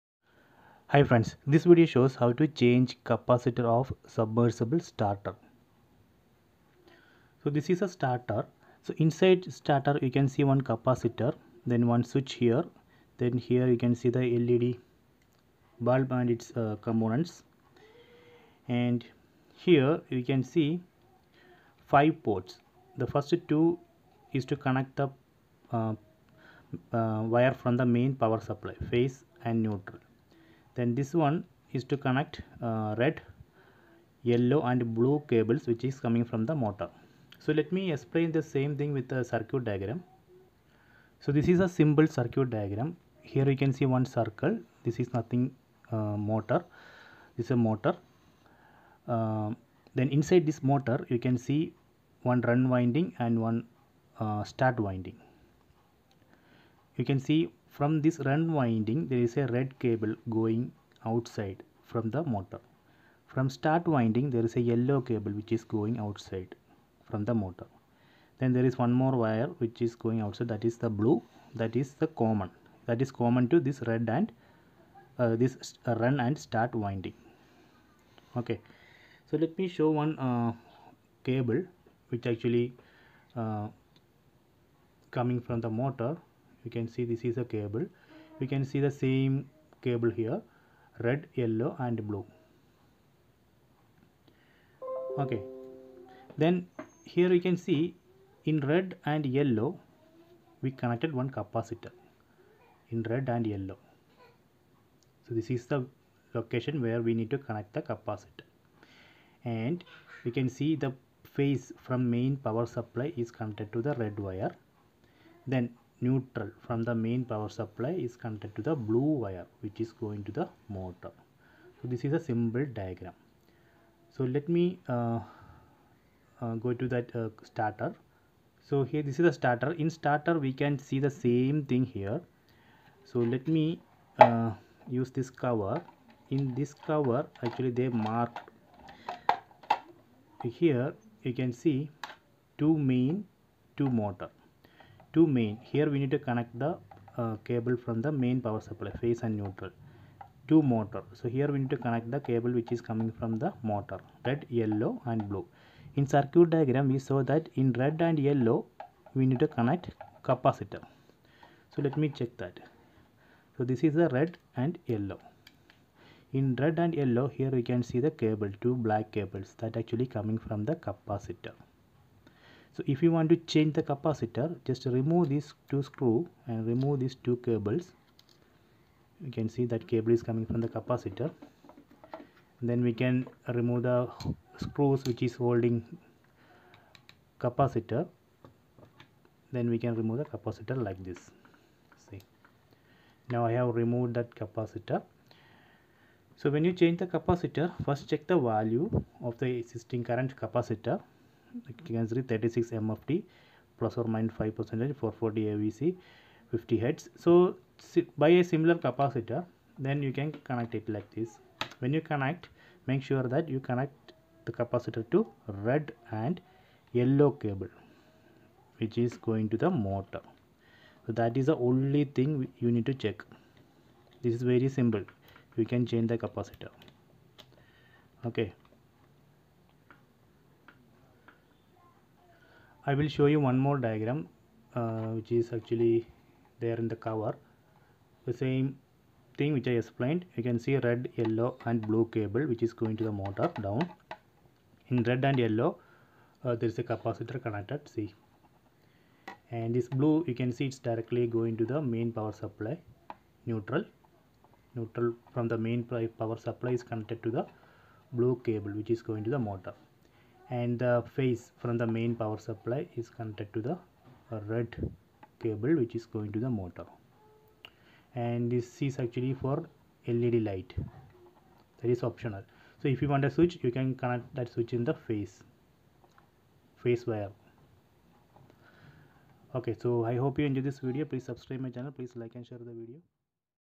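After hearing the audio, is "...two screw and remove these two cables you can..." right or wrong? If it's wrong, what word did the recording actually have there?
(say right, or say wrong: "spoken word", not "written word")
right.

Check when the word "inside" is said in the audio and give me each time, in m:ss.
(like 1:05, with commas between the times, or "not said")
0:08, 0:50.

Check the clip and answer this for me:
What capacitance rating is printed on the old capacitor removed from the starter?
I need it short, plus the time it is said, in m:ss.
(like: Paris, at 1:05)
36 mfd, at 3:22.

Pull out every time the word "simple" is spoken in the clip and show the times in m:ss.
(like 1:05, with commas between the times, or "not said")
0:41, 2:02, 3:44.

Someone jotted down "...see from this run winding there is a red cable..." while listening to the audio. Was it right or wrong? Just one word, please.
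right.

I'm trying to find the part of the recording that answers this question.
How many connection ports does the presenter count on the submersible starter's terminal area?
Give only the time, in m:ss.
0:21.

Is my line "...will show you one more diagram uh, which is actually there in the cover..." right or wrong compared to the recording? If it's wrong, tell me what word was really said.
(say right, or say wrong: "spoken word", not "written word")
right.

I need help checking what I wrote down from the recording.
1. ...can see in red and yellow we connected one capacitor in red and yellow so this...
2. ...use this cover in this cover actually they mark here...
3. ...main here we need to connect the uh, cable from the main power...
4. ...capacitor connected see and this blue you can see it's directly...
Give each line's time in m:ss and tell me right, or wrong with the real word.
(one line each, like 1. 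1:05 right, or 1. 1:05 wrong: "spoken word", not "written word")
1. 1:37 right
2. 2:14 right
3. 2:25 right
4. 4:06 right.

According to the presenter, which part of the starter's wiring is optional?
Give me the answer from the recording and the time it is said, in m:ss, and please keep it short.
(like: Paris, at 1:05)
LED light, at 4:30.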